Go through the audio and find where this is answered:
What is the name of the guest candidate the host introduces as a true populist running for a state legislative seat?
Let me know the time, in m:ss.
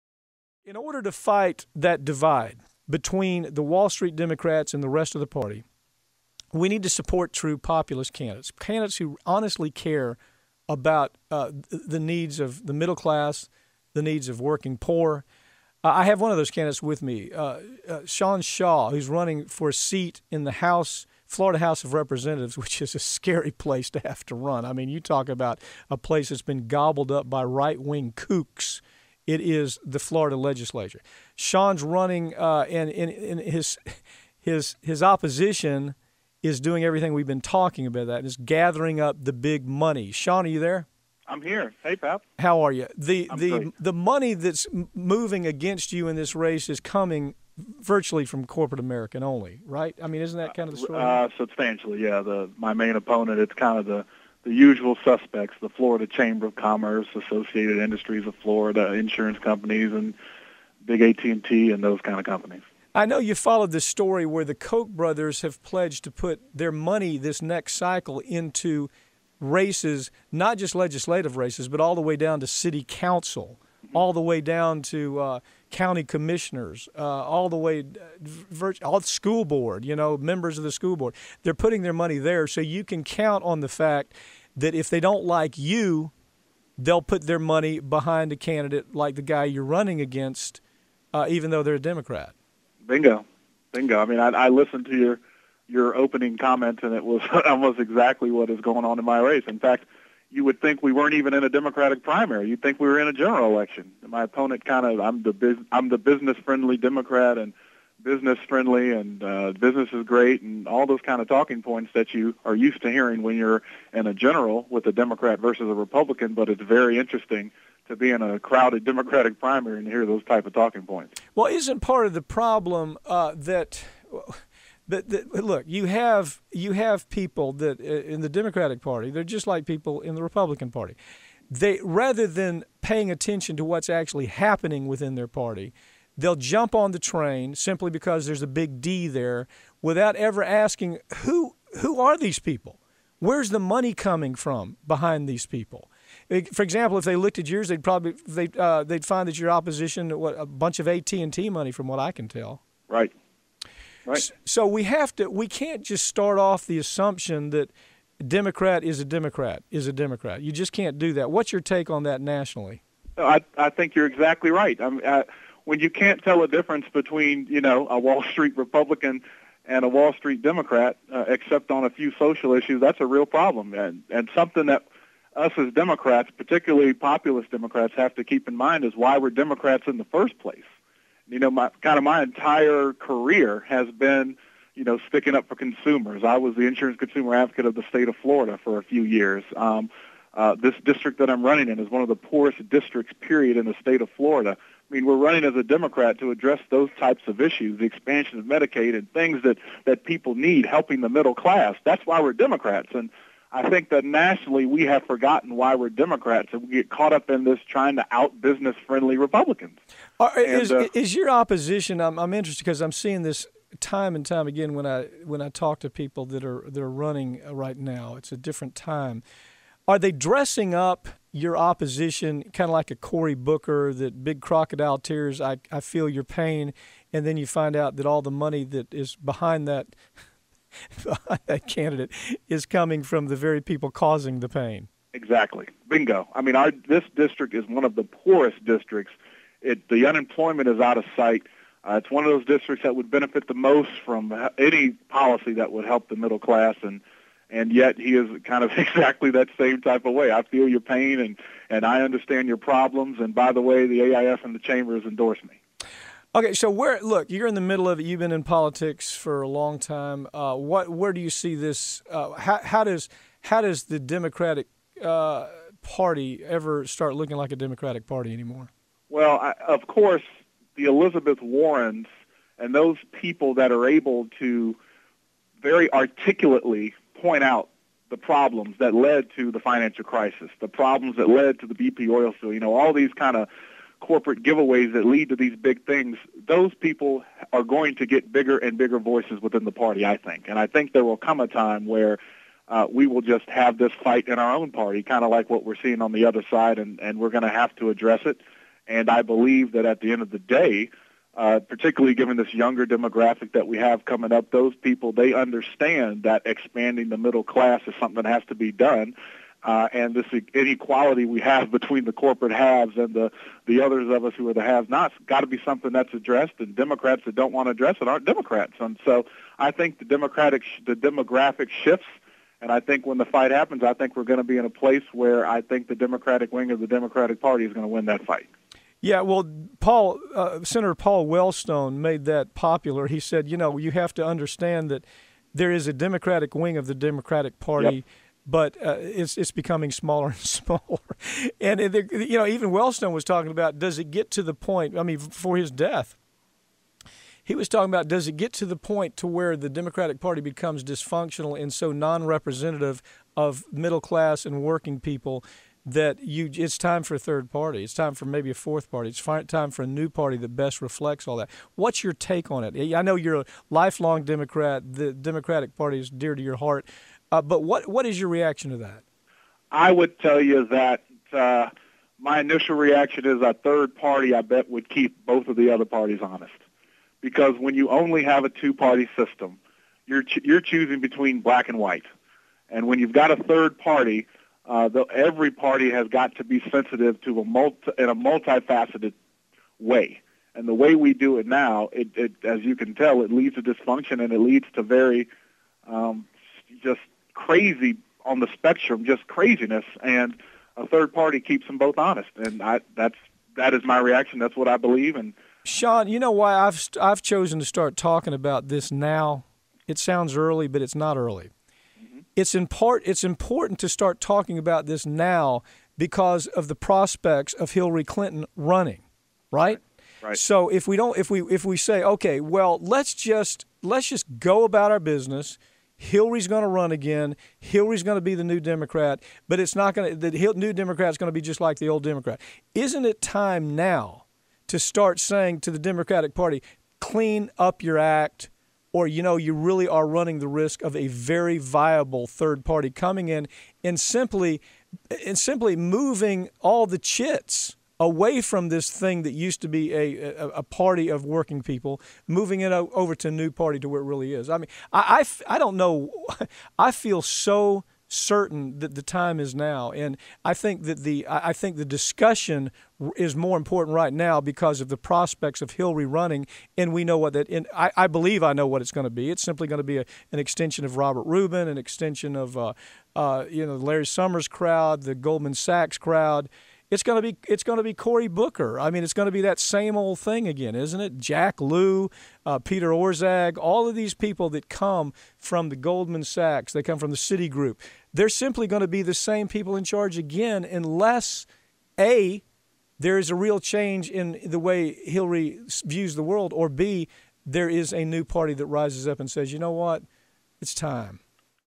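0:18.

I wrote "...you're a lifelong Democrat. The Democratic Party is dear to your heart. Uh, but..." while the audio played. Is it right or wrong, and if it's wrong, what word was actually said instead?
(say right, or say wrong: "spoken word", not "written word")
right.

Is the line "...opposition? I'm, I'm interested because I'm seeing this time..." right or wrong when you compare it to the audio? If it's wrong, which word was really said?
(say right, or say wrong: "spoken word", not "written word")
right.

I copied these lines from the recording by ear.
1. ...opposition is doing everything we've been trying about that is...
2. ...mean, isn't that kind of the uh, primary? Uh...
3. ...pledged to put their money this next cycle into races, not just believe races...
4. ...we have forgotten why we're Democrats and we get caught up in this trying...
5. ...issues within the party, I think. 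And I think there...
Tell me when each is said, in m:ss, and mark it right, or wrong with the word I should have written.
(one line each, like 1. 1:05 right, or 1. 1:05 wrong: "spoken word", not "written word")
1. 0:35 wrong: "talking", not "trying"
2. 0:50 wrong: "story", not "primary"
3. 1:05 wrong: "legislative", not "believe"
4. 3:24 right
5. 4:48 wrong: "voices", not "issues".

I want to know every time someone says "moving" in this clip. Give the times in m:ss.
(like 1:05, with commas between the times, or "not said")
0:44, 7:25, 7:32.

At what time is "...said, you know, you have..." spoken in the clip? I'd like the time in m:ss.
5:33.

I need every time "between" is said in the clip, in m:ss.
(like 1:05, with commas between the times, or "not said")
0:02, 2:46, 5:11, 6:20.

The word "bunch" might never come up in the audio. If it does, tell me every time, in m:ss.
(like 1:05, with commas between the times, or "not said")
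2:30.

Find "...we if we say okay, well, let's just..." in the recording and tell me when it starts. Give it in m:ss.
7:01.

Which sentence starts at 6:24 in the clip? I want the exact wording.
Uh, the, every party has got to be sensitive to a multi, in a multifaceted way.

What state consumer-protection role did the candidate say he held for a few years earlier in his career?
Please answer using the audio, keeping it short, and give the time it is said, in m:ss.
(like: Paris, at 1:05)
insurance consumer advocate, at 3:06.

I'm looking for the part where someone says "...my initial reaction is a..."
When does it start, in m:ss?
6:12.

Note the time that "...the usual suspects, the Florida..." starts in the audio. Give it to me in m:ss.
0:54.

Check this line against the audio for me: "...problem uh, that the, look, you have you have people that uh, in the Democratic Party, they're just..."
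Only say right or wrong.
right.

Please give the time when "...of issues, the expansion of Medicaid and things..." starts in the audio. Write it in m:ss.
3:17.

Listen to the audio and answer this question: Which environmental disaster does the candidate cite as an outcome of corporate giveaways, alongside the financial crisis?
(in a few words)
BP oil spill.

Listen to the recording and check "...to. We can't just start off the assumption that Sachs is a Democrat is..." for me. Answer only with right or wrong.
wrong.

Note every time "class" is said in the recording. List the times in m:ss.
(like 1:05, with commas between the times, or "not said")
0:12, 3:21, 4:06, 5:07, 5:54.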